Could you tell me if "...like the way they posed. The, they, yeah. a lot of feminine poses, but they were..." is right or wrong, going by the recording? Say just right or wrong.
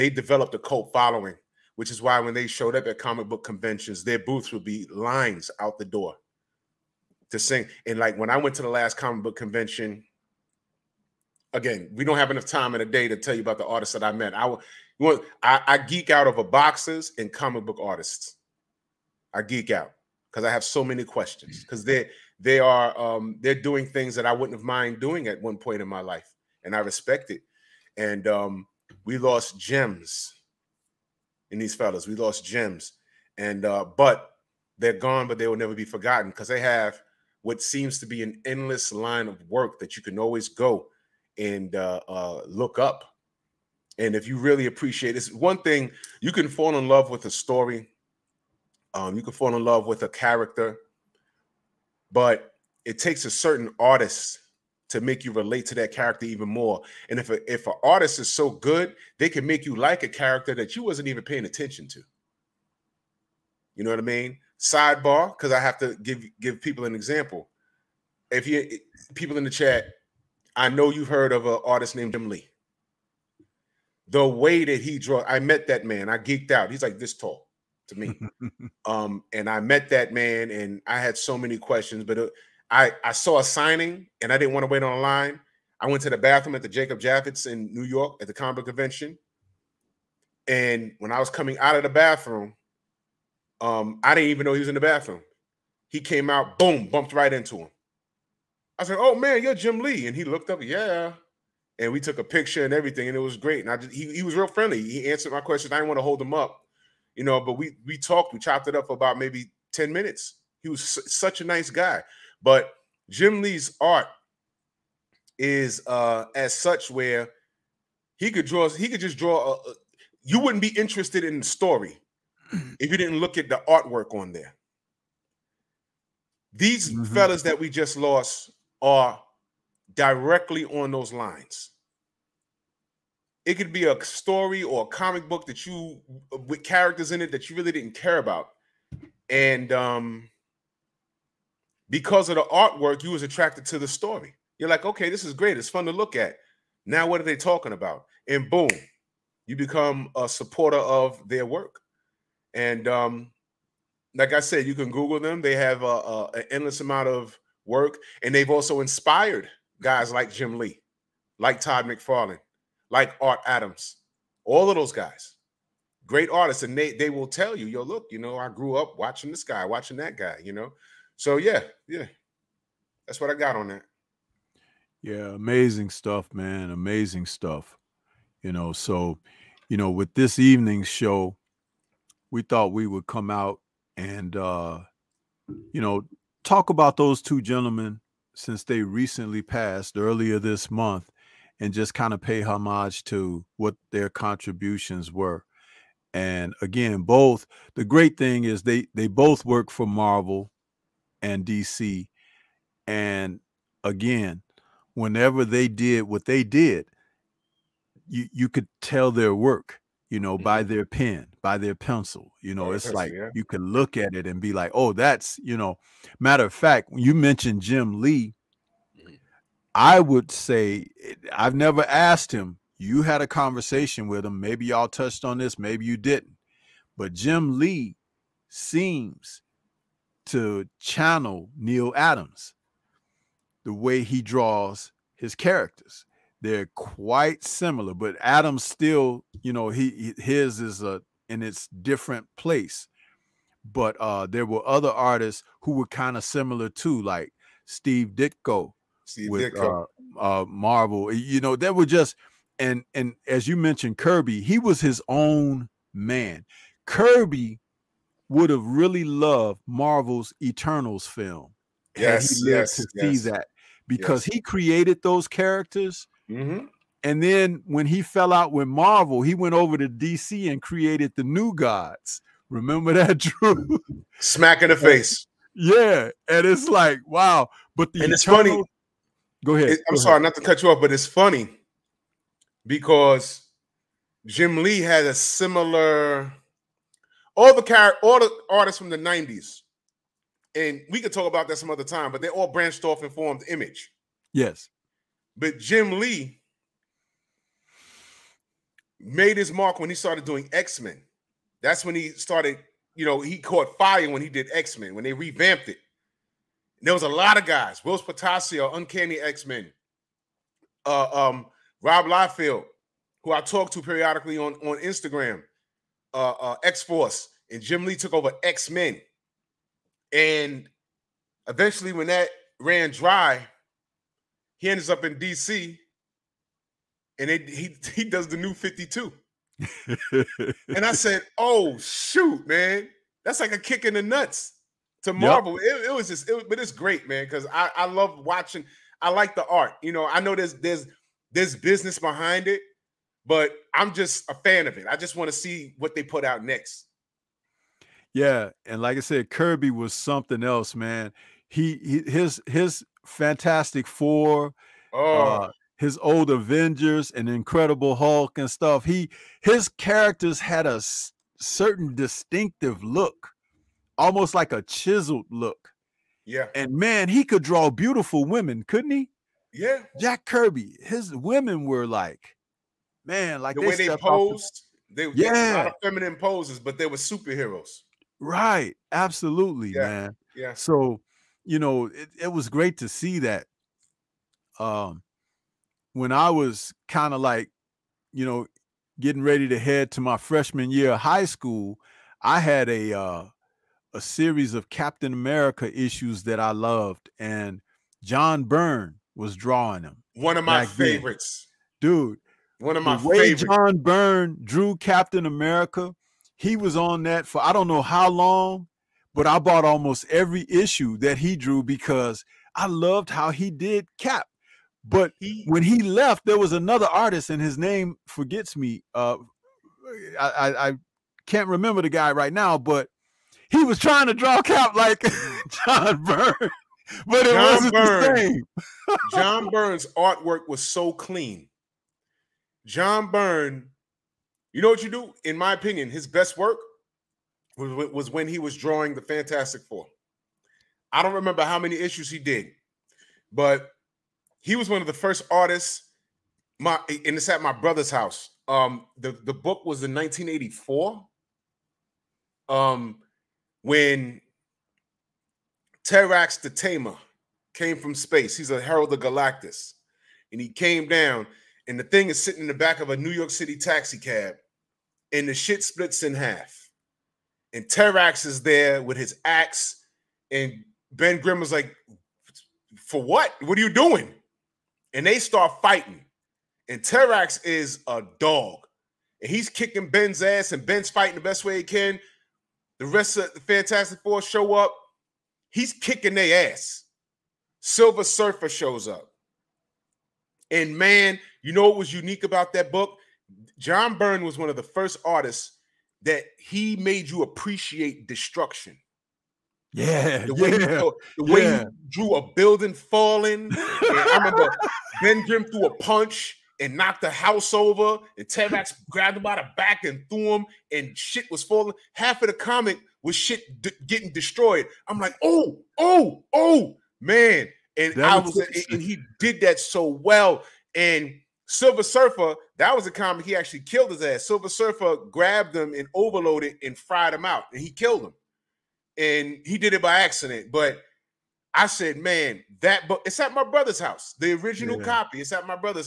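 right.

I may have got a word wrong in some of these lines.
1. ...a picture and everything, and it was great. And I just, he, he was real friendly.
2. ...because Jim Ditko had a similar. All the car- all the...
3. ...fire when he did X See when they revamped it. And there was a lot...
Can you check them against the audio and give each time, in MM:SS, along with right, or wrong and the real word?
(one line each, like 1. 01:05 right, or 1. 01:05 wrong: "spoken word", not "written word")
1. 01:42 right
2. 04:42 wrong: "Lee", not "Ditko"
3. 05:03 wrong: "Men", not "See".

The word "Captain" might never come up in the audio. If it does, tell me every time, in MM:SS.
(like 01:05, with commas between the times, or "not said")
06:34, 06:44.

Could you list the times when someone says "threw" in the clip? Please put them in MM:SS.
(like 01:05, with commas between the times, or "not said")
08:25, 08:30.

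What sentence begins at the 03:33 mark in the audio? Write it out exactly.
you can look at it and be like, oh, that's you know.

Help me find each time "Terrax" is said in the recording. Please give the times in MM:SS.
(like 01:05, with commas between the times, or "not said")
07:35, 07:47, 07:56, 08:28.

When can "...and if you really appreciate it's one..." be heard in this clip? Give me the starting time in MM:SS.
00:44.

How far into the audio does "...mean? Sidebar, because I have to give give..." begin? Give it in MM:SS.
01:04.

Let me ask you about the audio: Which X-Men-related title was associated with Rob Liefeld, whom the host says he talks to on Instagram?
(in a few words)
X-Force.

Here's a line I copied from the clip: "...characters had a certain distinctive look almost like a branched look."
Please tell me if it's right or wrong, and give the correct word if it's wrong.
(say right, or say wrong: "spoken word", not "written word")
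wrong: "chiseled", not "branched".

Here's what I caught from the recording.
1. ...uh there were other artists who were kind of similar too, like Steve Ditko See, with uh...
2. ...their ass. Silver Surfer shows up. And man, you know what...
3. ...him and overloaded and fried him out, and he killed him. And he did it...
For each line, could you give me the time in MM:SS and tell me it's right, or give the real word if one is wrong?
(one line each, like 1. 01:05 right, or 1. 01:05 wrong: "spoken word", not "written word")
1. 04:03 right
2. 08:06 right
3. 08:45 right.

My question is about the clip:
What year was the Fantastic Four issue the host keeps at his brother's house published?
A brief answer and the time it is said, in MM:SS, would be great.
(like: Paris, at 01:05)
1984, at 07:29.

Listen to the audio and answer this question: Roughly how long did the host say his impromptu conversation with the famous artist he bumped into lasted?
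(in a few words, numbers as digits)
10 minutes.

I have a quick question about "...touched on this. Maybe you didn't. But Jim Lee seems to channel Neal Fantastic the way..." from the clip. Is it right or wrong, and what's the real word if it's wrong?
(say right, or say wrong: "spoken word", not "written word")
wrong: "Adams", not "Fantastic".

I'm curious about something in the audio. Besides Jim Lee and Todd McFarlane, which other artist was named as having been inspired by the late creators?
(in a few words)
Art Adams.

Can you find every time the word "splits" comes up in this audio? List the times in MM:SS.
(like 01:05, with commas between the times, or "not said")
07:45.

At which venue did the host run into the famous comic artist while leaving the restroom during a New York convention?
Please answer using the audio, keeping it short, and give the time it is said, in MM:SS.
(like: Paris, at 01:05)
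Jacob Javits, at 01:26.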